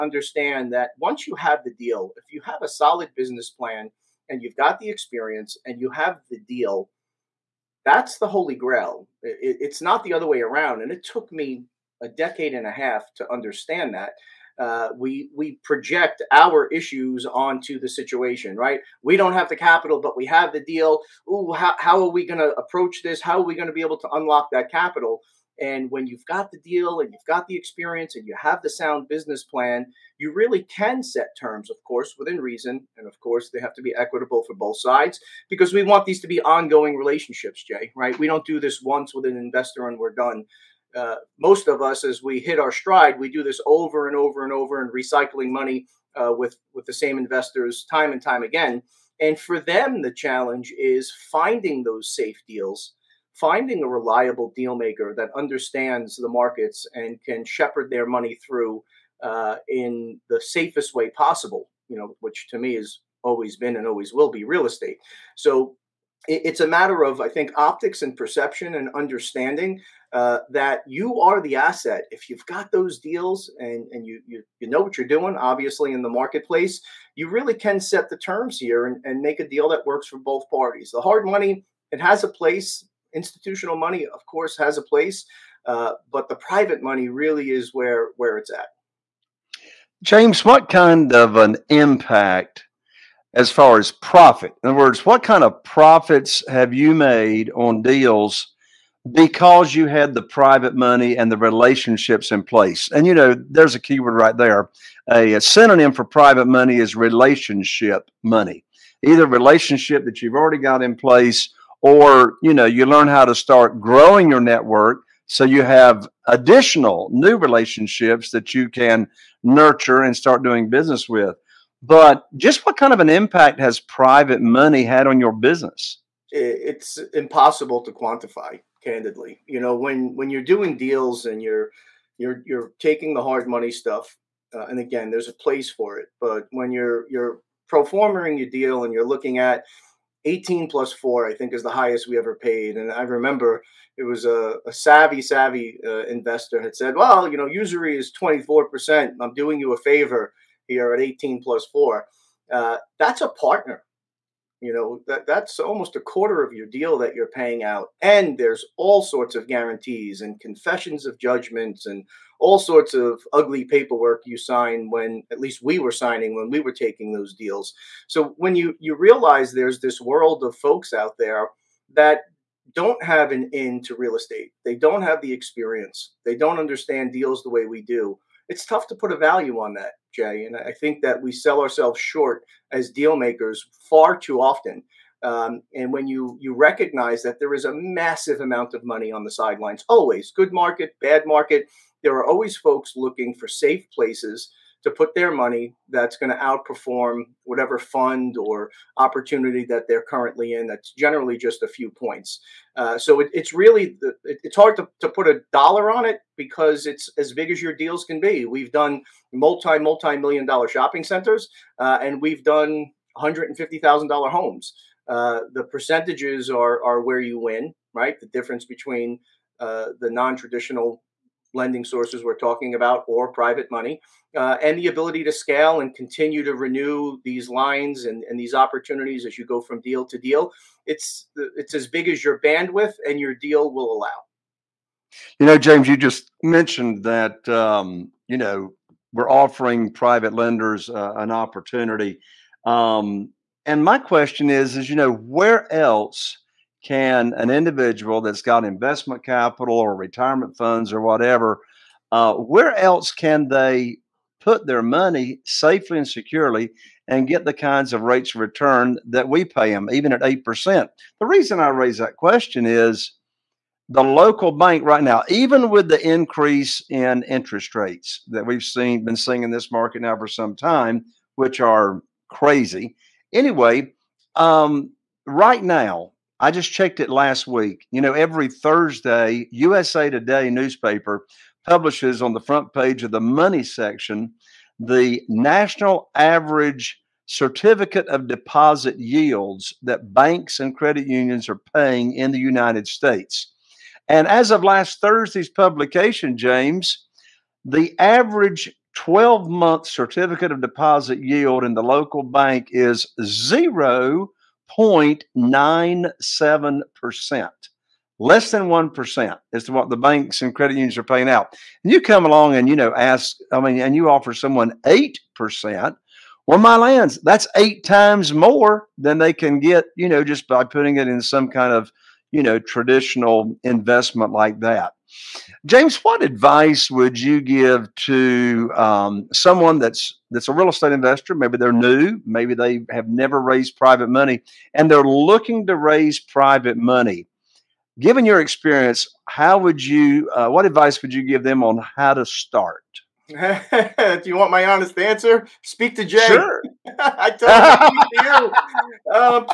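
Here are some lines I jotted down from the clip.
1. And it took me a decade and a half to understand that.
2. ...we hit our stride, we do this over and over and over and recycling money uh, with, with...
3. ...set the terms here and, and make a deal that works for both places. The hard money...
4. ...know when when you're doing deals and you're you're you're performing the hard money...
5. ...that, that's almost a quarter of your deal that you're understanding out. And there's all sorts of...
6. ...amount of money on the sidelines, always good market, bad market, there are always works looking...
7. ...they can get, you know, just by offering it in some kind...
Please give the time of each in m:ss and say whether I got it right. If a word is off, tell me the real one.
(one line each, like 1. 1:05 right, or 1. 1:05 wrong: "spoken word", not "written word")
1. 0:10 right
2. 0:42 right
3. 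1:17 wrong: "parties", not "places"
4. 2:09 wrong: "taking", not "performing"
5. 2:35 wrong: "paying", not "understanding"
6. 3:08 wrong: "folks", not "works"
7. 5:19 wrong: "putting", not "offering".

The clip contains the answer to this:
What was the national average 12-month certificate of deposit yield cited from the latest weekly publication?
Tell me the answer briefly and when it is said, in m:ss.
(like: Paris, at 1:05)
0.97%, at 5:04.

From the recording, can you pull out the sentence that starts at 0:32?
And of course, they have to be equitable for both sides because we want these to be ongoing relationships, Jay, right?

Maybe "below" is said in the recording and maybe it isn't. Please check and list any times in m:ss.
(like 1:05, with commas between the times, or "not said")
not said.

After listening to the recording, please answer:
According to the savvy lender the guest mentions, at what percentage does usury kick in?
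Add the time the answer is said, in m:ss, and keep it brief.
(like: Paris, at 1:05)
24%, at 2:28.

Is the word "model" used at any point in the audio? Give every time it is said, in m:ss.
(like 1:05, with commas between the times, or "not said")
not said.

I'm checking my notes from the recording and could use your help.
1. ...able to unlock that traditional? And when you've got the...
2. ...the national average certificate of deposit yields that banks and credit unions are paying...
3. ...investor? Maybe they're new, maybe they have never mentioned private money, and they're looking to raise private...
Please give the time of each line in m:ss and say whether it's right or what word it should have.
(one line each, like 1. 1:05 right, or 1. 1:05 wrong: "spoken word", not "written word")
1. 0:23 wrong: "capital", not "traditional"
2. 4:44 right
3. 5:30 wrong: "raised", not "mentioned".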